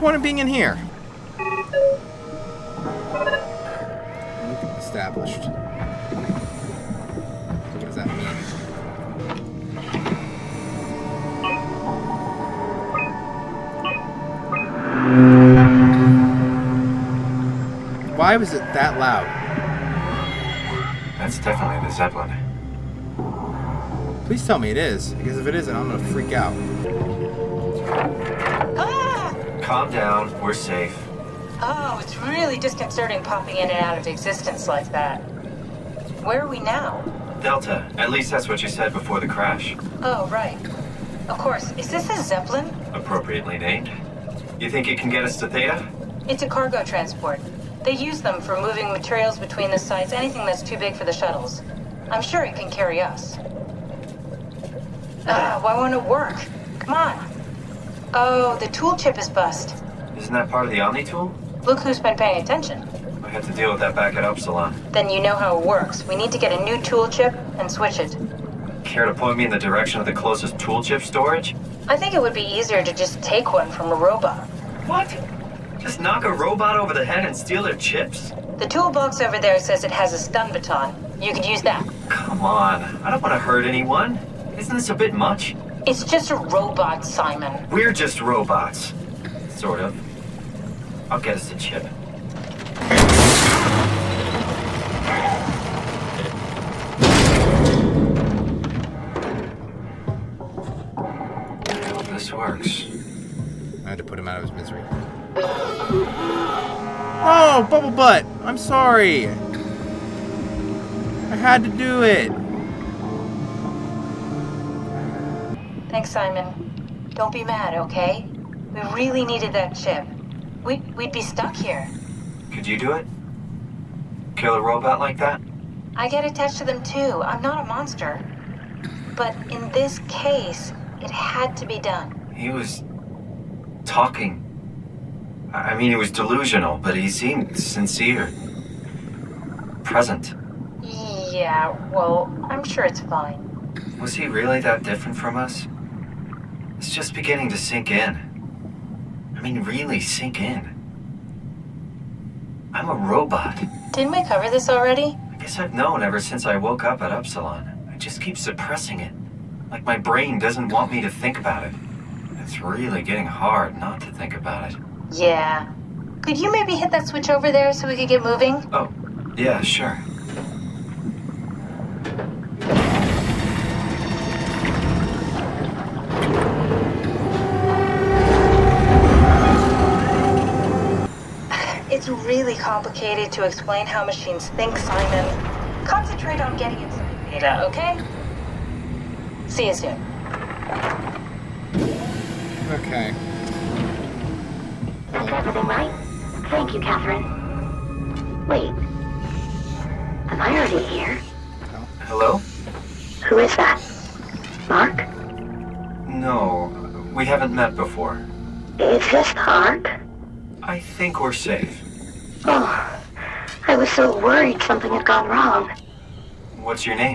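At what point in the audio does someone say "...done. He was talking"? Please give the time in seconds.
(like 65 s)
131 s.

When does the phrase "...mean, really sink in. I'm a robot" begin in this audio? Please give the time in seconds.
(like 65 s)
149 s.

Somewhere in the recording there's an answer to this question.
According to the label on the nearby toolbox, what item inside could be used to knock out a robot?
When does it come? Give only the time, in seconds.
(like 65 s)
80 s.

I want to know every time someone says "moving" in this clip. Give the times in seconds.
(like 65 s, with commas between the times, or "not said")
48 s, 168 s.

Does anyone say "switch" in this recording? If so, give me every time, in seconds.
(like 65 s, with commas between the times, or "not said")
67 s, 167 s.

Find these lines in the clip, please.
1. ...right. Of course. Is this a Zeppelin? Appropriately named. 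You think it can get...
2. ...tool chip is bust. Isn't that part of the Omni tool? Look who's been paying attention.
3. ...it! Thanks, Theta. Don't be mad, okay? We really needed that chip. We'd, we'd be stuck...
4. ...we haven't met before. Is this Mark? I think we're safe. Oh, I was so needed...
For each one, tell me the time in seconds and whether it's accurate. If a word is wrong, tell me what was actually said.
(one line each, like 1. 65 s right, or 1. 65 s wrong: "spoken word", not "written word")
1. 40 s right
2. 58 s right
3. 112 s wrong: "Simon", not "Theta"
4. 207 s wrong: "worried", not "needed".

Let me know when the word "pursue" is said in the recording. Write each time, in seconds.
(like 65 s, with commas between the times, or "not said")
not said.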